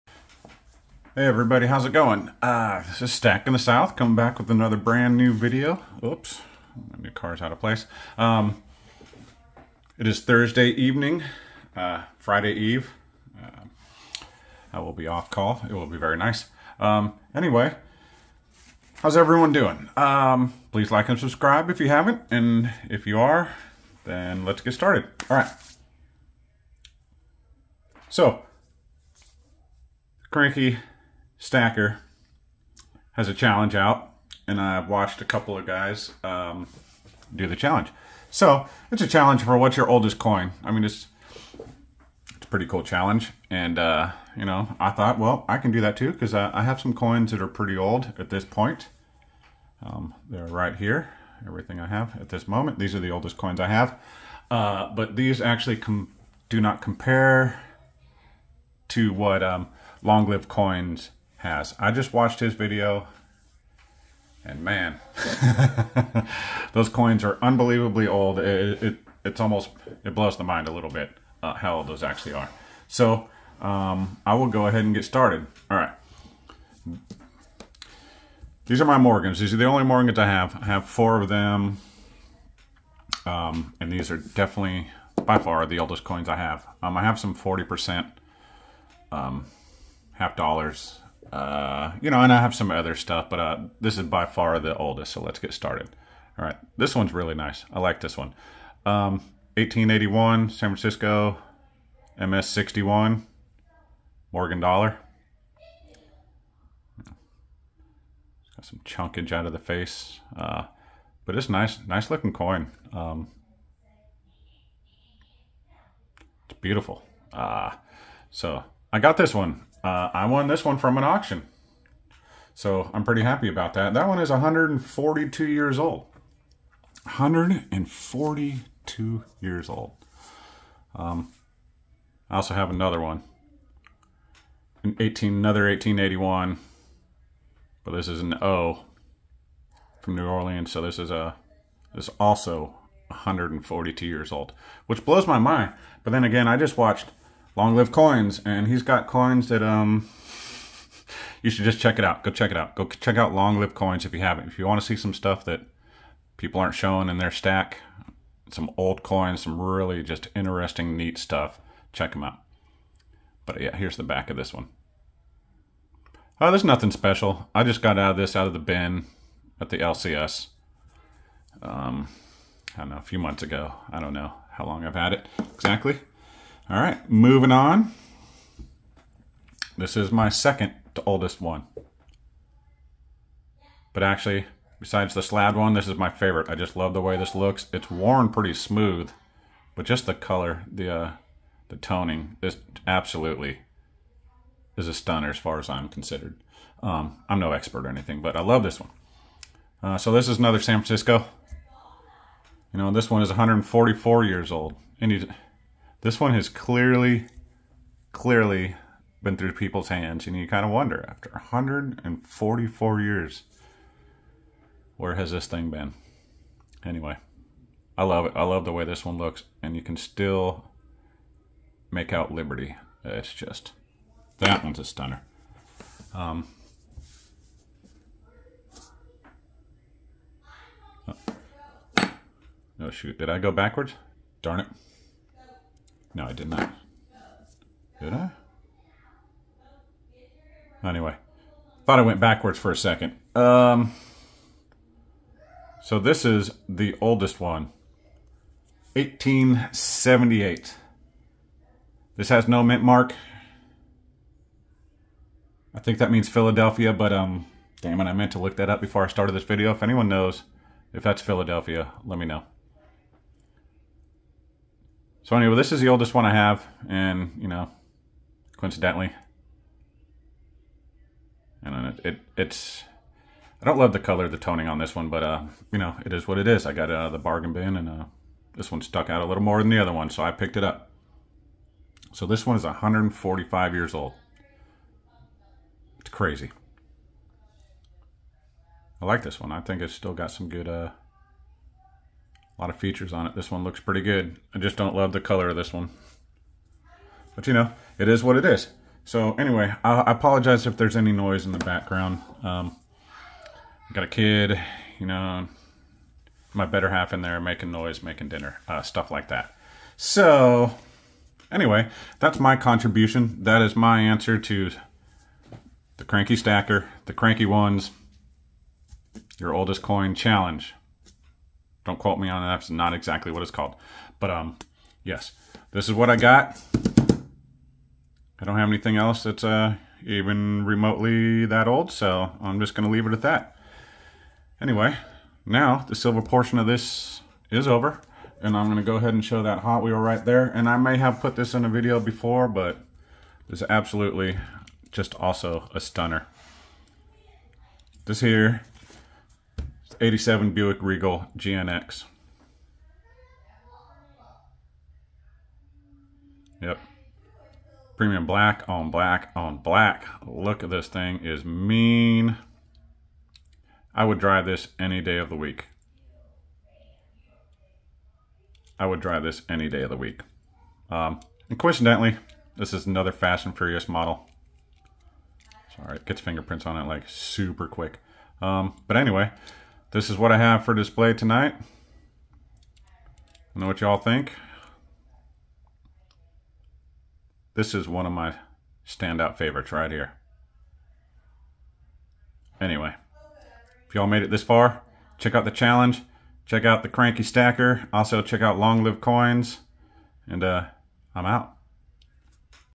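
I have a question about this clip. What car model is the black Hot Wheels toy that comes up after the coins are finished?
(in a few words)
87 Buick Regal GNX.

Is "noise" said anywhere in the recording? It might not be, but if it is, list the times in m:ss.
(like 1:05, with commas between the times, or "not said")
5:01, 5:07.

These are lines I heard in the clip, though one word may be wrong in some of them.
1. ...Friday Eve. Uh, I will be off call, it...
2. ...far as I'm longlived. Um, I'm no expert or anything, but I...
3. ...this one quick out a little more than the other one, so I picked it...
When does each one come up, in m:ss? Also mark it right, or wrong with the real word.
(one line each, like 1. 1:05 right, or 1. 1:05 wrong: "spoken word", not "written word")
1. 0:12 right
2. 3:15 wrong: "considered", not "longlived"
3. 4:38 wrong: "stuck", not "quick".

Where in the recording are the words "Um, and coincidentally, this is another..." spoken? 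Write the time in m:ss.
6:10.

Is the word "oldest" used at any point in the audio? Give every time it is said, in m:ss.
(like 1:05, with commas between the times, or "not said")
0:39, 0:53, 1:25, 1:34, 3:01, 4:06, 4:25, 5:19.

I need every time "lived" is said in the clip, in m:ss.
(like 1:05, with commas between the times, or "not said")
1:00, 2:27, 2:33, 6:38.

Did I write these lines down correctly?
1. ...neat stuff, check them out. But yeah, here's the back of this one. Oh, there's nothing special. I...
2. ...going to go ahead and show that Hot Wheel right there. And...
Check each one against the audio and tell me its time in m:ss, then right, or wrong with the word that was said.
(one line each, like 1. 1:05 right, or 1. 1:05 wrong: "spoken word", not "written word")
1. 2:40 right
2. 5:38 right.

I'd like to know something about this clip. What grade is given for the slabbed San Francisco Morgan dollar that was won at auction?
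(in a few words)
MS-61.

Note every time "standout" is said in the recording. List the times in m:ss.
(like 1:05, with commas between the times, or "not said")
6:28.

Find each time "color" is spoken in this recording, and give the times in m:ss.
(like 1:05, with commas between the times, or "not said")
3:10, 4:33, 4:55.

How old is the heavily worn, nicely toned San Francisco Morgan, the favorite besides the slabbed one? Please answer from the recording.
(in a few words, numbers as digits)
144.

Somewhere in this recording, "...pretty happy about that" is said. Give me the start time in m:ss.
2:03.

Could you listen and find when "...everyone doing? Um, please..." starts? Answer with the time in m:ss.
0:19.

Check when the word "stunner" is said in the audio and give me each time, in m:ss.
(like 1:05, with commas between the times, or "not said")
3:14, 3:44, 5:45.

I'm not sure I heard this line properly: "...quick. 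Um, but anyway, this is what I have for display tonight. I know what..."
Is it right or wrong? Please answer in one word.
right.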